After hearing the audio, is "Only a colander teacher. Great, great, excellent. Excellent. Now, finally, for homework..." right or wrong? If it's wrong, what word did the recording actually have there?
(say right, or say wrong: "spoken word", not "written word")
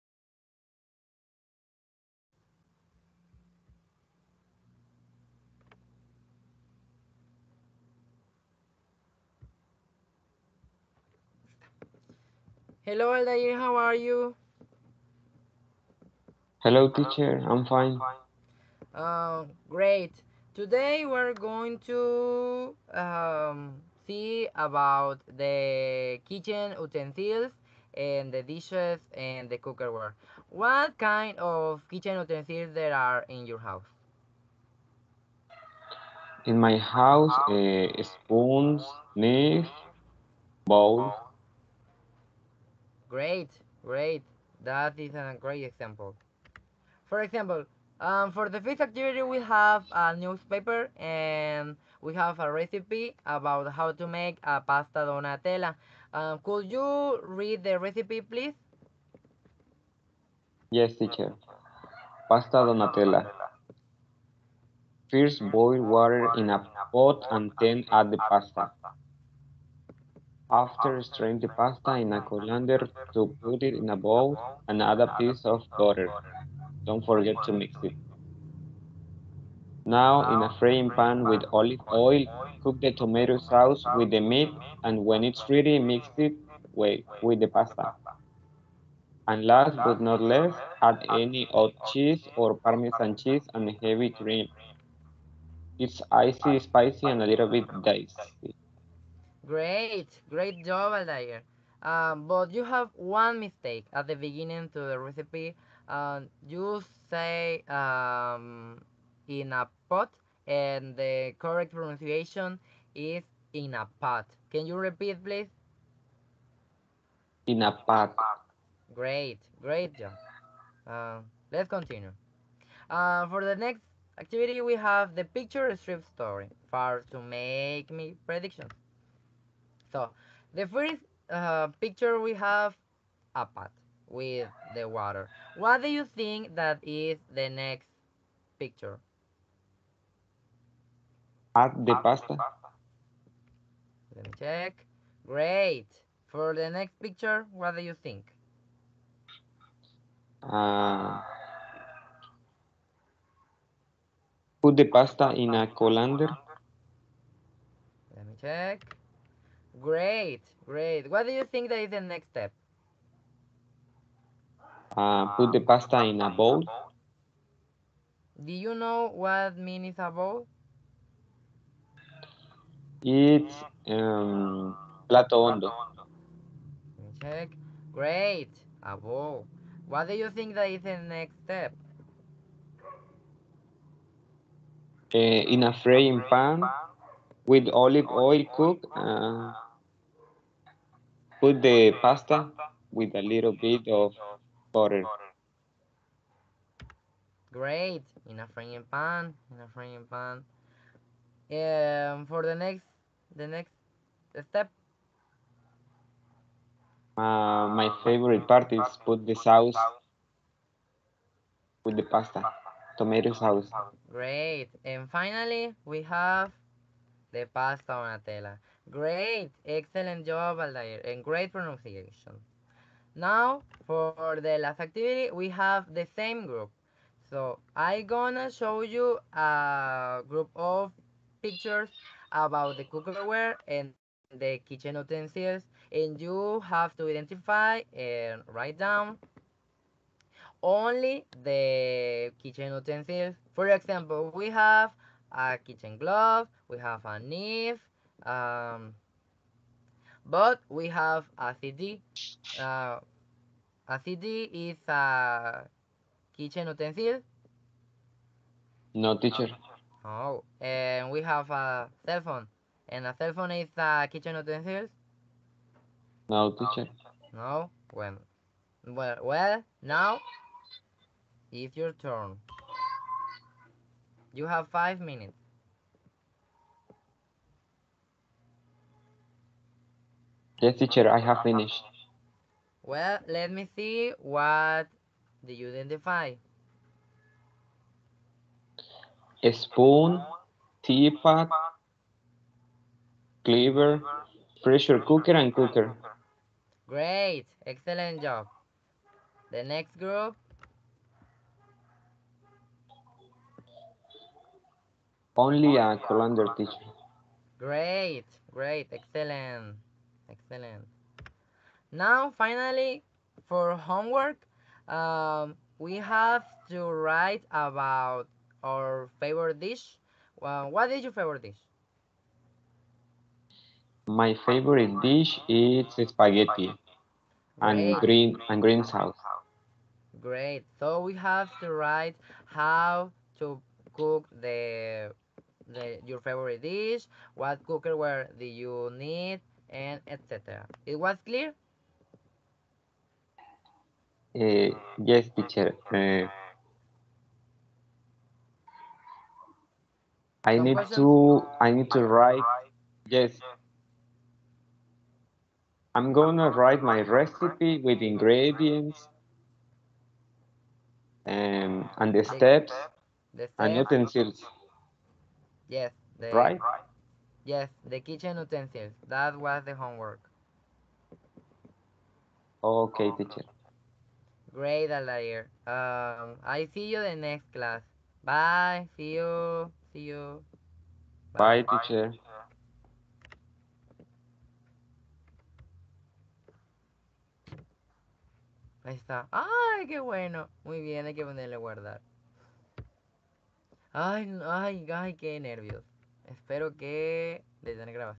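right.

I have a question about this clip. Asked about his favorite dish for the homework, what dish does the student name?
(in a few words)
spaghetti.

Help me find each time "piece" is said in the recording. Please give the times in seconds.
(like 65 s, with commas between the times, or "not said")
75 s.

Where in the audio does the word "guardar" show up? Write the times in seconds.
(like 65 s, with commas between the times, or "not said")
391 s.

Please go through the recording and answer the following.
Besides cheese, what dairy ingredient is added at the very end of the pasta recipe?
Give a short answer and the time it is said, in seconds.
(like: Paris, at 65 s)
heavy cream, at 93 s.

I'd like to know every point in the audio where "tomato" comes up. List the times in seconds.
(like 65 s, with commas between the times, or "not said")
82 s, 212 s.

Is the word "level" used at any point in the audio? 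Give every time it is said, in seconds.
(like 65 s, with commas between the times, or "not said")
not said.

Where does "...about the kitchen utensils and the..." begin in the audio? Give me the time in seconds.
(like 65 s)
24 s.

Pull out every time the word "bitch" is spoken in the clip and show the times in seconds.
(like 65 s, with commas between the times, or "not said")
not said.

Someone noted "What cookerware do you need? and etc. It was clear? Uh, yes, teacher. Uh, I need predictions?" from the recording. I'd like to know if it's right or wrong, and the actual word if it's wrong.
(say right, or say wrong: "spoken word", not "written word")
wrong: "questions", not "predictions".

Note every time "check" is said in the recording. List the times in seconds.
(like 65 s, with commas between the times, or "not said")
144 s, 158 s, 177 s.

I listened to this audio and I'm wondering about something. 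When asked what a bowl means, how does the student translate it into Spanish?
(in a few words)
plato hondo.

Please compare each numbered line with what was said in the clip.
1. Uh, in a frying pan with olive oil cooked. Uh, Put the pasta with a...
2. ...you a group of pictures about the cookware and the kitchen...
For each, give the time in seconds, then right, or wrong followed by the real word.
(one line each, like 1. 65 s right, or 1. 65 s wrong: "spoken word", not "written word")
1. 185 s right
2. 228 s right.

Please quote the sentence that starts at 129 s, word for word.
So the first uh, picture we have a pot with the water.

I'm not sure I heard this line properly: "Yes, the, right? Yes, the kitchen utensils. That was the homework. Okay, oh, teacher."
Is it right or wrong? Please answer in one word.
right.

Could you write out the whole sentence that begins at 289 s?
A spoon, teapot, cleaver, pressure cooker, and cooker.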